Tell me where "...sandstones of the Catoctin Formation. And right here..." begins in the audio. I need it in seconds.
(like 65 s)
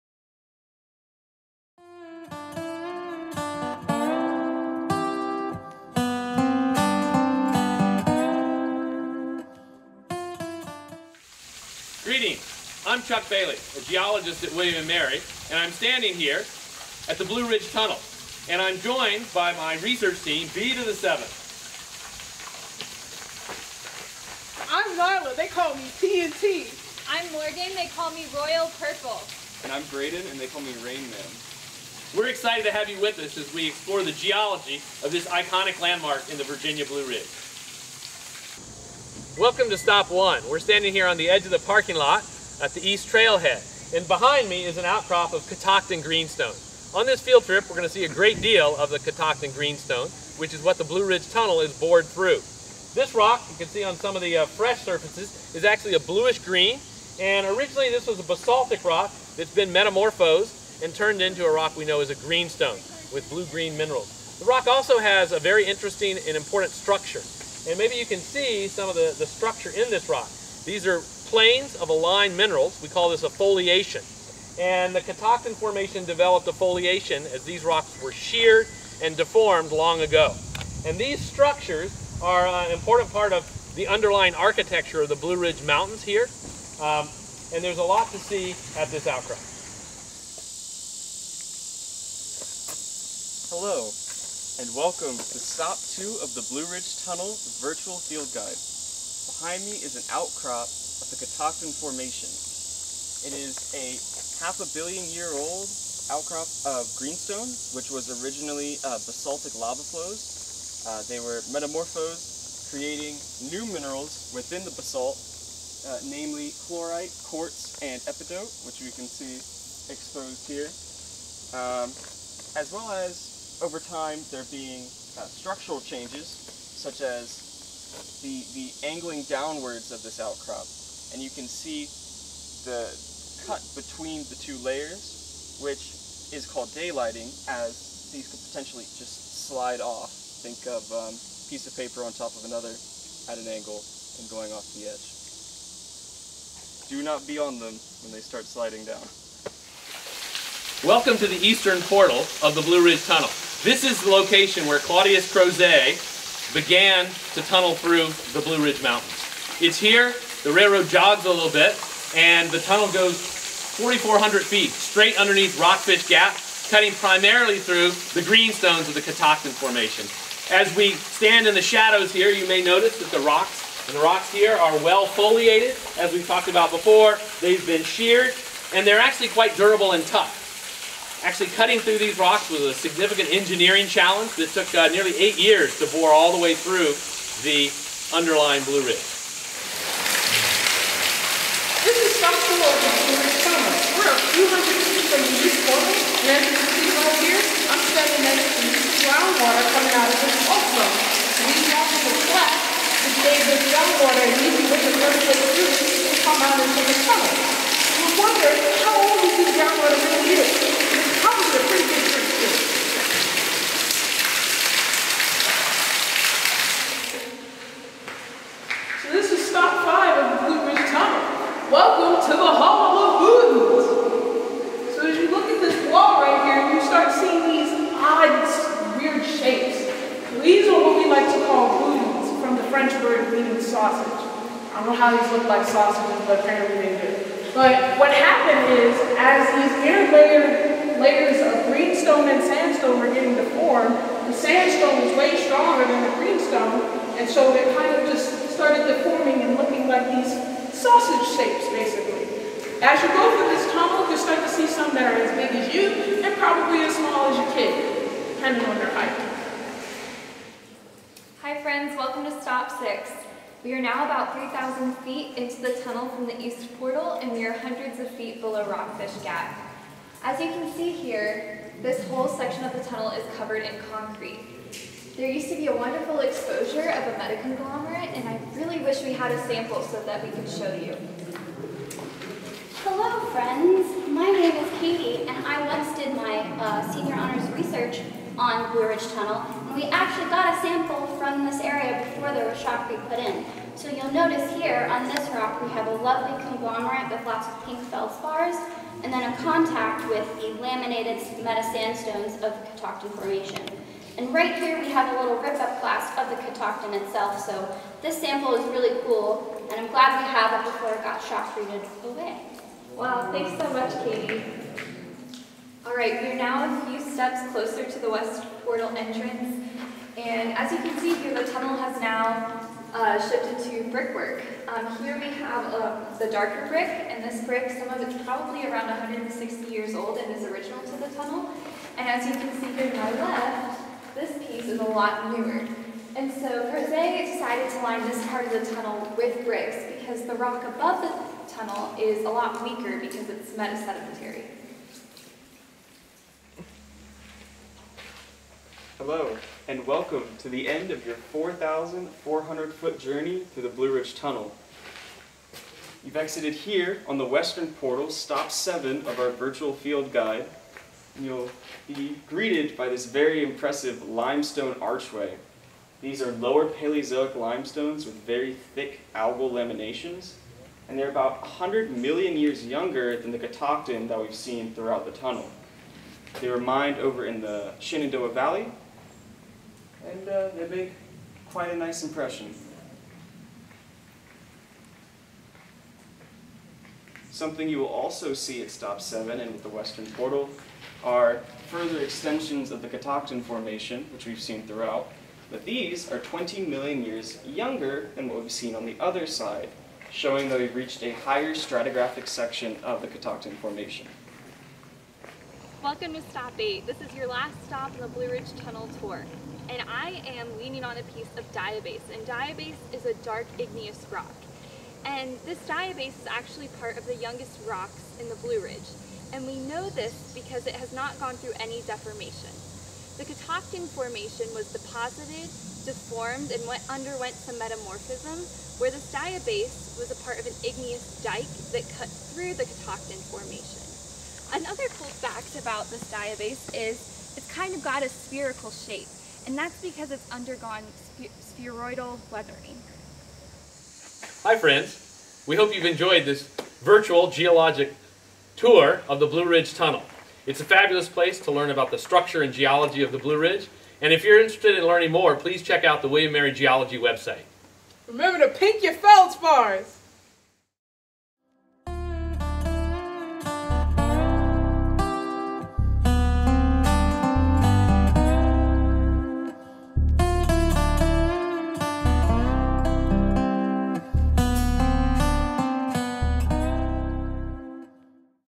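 301 s.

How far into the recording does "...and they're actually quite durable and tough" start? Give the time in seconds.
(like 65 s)
178 s.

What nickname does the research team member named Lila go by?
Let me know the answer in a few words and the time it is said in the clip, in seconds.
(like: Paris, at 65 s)
TNT, at 26 s.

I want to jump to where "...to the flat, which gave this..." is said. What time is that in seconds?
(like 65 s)
201 s.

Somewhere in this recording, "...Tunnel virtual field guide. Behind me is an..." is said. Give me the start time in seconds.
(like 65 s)
97 s.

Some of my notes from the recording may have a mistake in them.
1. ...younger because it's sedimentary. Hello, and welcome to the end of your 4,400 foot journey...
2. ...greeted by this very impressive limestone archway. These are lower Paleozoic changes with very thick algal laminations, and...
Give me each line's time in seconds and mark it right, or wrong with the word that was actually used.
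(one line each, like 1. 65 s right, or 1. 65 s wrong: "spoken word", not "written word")
1. 342 s wrong: "weaker", not "younger"
2. 362 s wrong: "limestones", not "changes".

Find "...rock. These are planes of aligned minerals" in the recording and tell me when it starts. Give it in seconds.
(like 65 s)
70 s.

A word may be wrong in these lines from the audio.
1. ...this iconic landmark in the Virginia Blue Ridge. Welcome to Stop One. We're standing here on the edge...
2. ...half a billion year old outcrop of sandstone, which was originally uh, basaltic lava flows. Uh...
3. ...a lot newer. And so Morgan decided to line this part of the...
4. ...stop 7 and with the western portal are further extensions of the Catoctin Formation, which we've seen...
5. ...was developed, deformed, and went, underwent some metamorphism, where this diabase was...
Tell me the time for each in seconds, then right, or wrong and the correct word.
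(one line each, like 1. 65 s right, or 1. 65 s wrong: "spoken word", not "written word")
1. 35 s right
2. 104 s wrong: "greenstone", not "sandstone"
3. 334 s wrong: "Crozet", not "Morgan"
4. 388 s right
5. 424 s wrong: "deposited", not "developed".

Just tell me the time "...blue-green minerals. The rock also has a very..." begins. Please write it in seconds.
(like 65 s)
63 s.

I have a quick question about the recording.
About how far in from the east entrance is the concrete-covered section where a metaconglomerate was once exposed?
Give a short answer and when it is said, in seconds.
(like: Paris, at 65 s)
3,000 feet, at 264 s.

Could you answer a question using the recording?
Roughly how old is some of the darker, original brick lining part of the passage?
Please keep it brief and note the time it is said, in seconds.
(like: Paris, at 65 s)
160 years, at 328 s.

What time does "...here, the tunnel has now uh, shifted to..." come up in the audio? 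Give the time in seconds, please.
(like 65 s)
321 s.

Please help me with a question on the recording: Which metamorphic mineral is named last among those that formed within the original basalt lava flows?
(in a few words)
epidote.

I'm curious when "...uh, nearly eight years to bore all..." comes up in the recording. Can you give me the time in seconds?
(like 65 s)
184 s.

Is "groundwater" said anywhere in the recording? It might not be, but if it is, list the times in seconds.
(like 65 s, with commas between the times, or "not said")
199 s, 203 s, 209 s.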